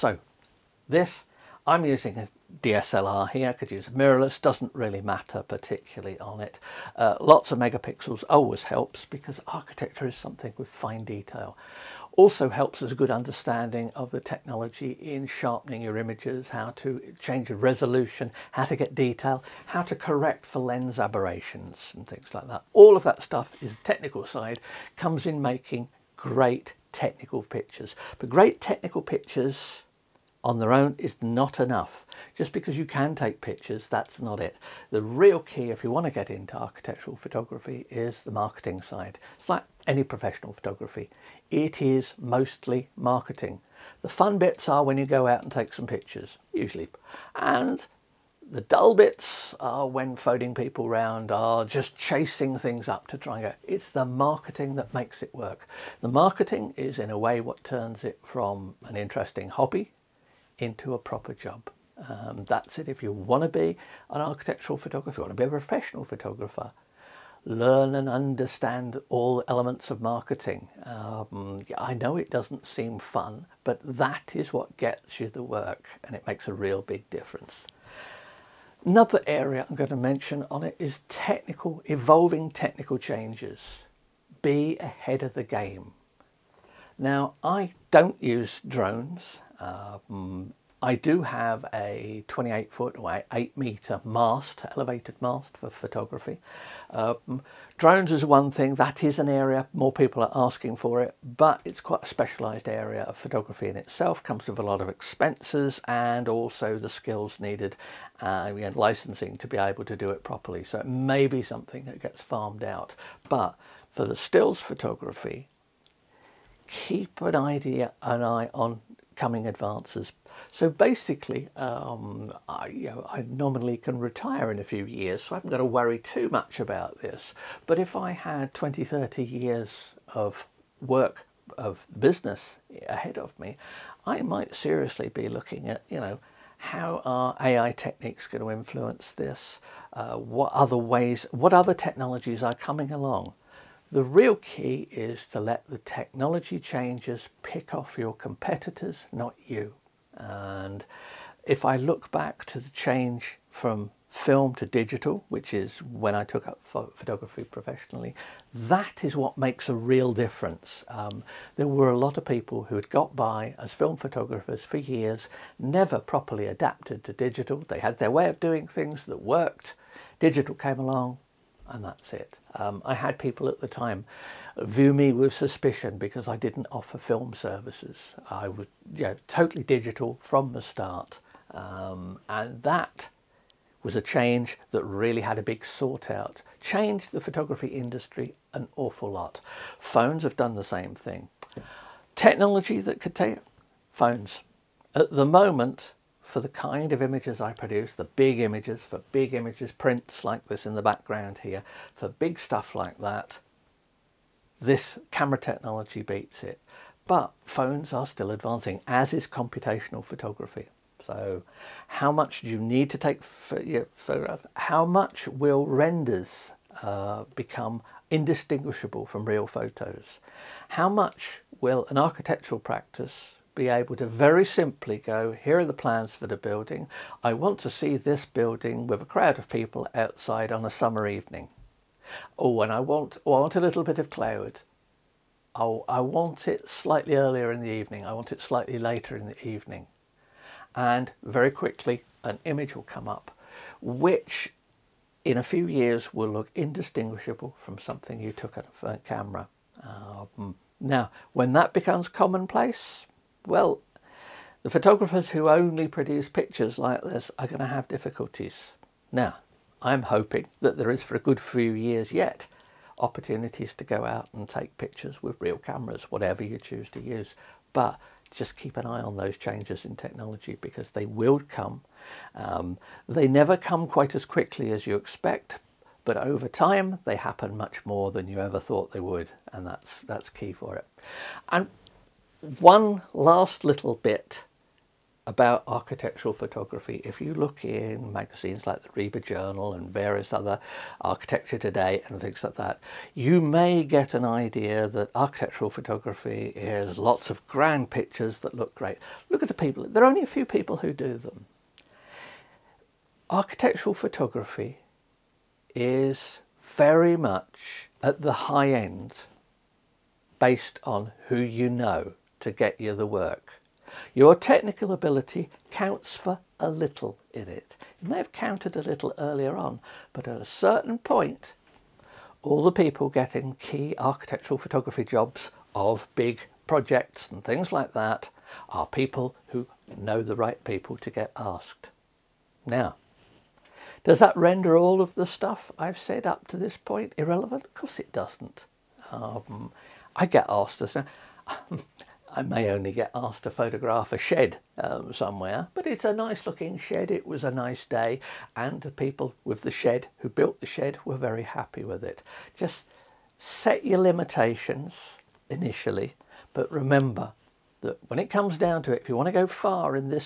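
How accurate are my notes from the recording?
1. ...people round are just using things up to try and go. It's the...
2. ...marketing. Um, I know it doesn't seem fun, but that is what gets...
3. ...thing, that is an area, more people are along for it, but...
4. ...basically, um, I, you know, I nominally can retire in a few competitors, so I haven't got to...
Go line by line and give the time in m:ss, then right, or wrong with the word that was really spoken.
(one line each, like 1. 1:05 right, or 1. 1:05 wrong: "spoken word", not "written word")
1. 0:50 wrong: "chasing", not "using"
2. 1:10 right
3. 1:38 wrong: "asking", not "along"
4. 2:00 wrong: "years", not "competitors".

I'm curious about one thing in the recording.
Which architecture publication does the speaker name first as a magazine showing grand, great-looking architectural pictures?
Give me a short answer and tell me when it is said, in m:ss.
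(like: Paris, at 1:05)
RIBA Journal, at 4:48.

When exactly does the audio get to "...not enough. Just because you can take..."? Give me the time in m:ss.
0:31.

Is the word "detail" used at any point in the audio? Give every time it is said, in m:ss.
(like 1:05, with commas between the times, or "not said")
0:11, 0:18.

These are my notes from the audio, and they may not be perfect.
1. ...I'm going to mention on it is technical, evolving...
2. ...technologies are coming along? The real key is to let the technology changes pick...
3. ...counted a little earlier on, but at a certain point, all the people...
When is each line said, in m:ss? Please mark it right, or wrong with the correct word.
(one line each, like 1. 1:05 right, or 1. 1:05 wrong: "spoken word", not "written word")
1. 1:19 right
2. 2:21 right
3. 5:18 right.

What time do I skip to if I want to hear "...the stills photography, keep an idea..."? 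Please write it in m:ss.
1:54.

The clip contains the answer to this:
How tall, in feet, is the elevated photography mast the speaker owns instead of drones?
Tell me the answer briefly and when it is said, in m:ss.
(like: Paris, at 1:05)
28 feet, at 1:32.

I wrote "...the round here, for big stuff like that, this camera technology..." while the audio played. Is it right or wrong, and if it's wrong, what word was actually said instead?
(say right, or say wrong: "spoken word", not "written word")
wrong: "background", not "round".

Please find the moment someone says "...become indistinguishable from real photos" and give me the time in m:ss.
3:37.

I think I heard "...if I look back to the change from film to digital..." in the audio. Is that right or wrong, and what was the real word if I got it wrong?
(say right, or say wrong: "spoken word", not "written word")
right.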